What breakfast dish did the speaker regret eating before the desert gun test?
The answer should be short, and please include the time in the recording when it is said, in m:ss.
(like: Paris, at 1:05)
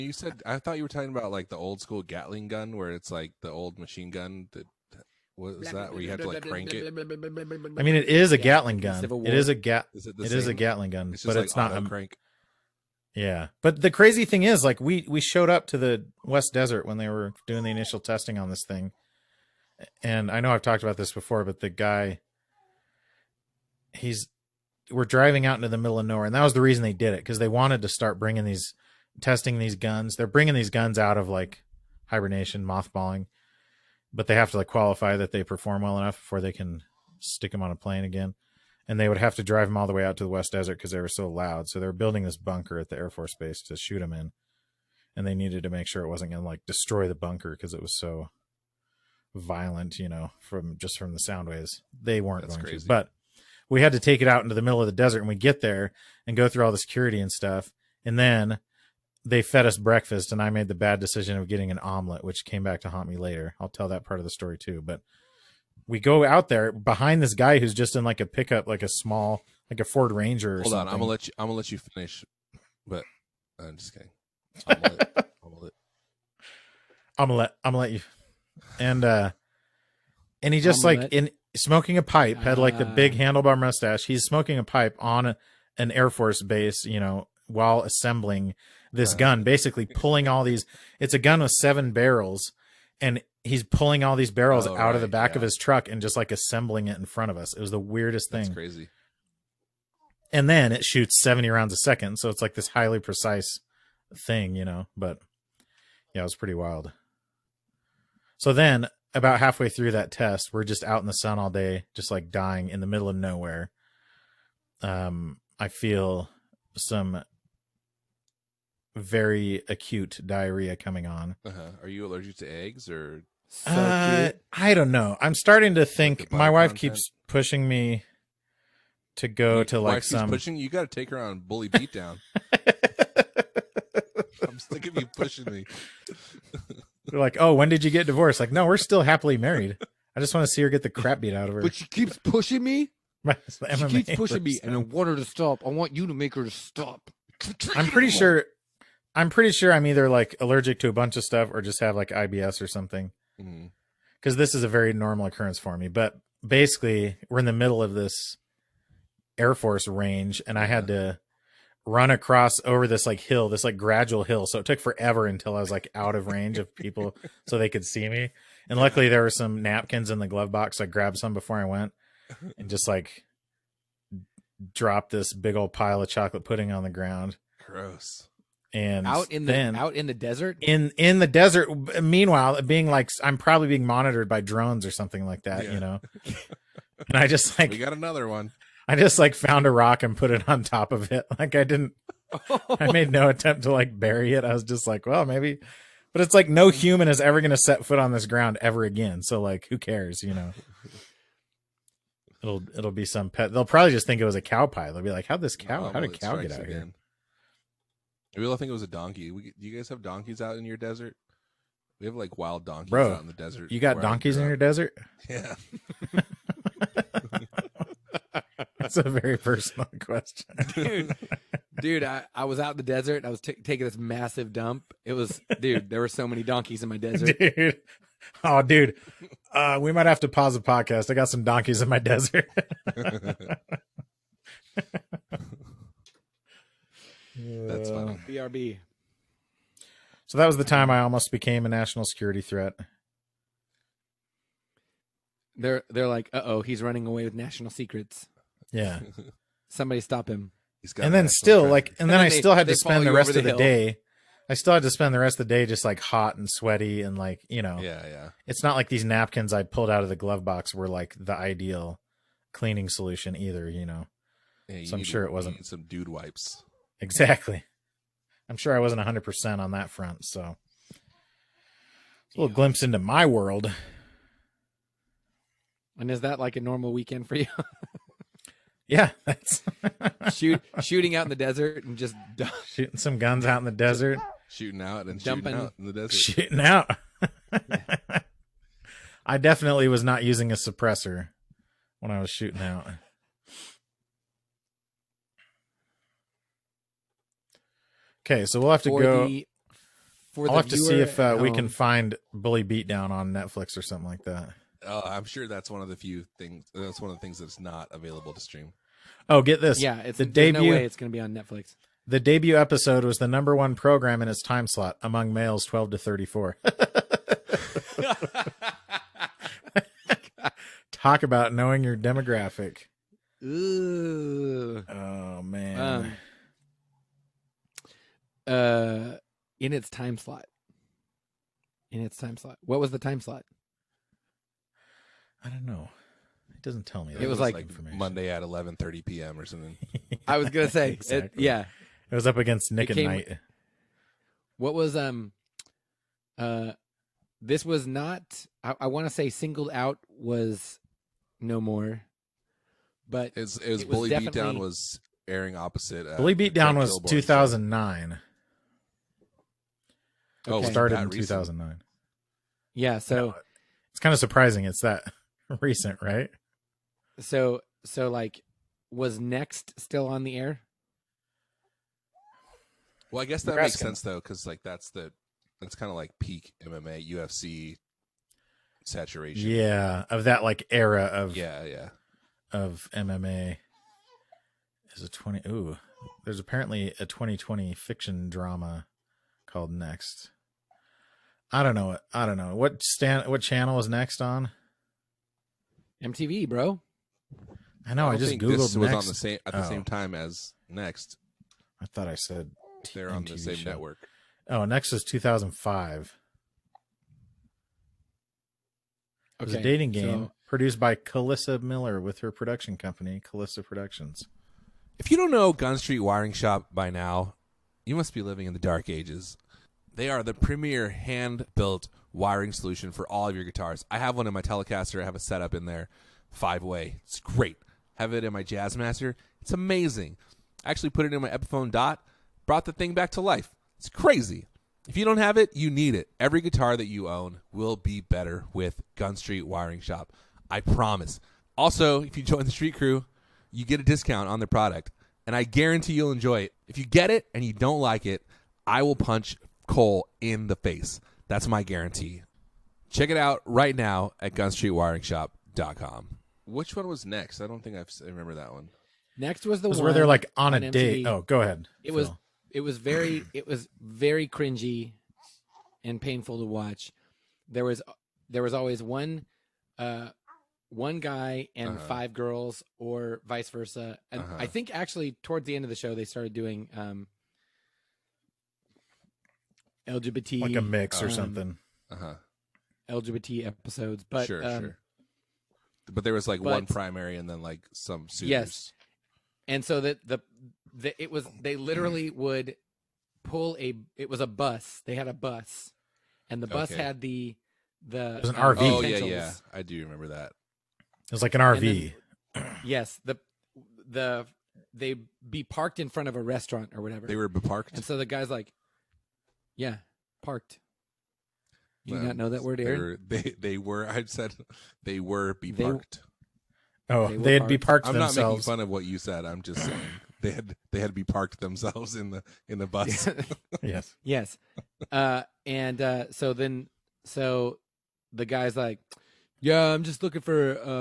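An omelet, at 1:01.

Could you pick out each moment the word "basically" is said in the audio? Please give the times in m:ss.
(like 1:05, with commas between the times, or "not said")
1:29, 2:36.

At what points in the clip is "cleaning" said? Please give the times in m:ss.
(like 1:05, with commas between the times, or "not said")
4:22.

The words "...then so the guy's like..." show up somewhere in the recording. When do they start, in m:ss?
8:46.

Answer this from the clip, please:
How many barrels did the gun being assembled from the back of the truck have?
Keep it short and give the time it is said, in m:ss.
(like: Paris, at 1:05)
7, at 1:31.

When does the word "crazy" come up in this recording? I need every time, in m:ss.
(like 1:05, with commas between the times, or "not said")
0:13, 0:52, 1:38, 7:13.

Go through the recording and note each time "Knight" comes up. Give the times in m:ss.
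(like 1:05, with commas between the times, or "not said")
5:43.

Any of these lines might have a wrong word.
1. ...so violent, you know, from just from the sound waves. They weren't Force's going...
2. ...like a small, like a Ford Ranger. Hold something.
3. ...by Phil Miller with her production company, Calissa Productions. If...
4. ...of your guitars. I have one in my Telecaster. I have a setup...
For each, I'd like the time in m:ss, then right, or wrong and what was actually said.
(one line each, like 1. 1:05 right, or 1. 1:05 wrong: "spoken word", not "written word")
1. 0:47 wrong: "That", not "Force"
2. 1:08 right
3. 6:50 wrong: "Calissa", not "Phil"
4. 7:03 right.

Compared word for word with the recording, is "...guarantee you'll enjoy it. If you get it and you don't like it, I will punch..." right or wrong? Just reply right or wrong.
right.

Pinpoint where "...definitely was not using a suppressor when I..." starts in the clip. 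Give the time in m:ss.
4:49.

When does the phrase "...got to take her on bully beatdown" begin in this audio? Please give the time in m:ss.
2:10.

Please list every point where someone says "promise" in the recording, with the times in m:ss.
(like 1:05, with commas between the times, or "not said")
7:20.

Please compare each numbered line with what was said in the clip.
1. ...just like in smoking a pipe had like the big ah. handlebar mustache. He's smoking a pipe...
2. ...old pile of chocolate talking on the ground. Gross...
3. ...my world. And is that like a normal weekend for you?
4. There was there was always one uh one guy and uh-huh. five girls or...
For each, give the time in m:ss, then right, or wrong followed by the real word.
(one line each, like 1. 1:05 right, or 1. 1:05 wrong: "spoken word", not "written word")
1. 1:20 right
2. 2:55 wrong: "pudding", not "talking"
3. 4:32 right
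4. 7:47 right.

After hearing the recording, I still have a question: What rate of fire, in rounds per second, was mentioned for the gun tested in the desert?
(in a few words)
70.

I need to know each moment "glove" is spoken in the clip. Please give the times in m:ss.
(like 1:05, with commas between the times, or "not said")
2:50, 4:20.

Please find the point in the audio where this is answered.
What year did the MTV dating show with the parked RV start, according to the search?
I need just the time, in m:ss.
6:45.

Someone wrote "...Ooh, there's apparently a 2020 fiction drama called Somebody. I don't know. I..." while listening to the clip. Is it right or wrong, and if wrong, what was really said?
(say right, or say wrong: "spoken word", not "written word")
wrong: "Next", not "Somebody".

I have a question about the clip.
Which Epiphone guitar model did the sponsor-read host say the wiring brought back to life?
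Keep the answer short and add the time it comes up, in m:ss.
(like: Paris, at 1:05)
Dot, at 7:11.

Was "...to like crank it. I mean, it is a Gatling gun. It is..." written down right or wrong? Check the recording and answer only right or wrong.
right.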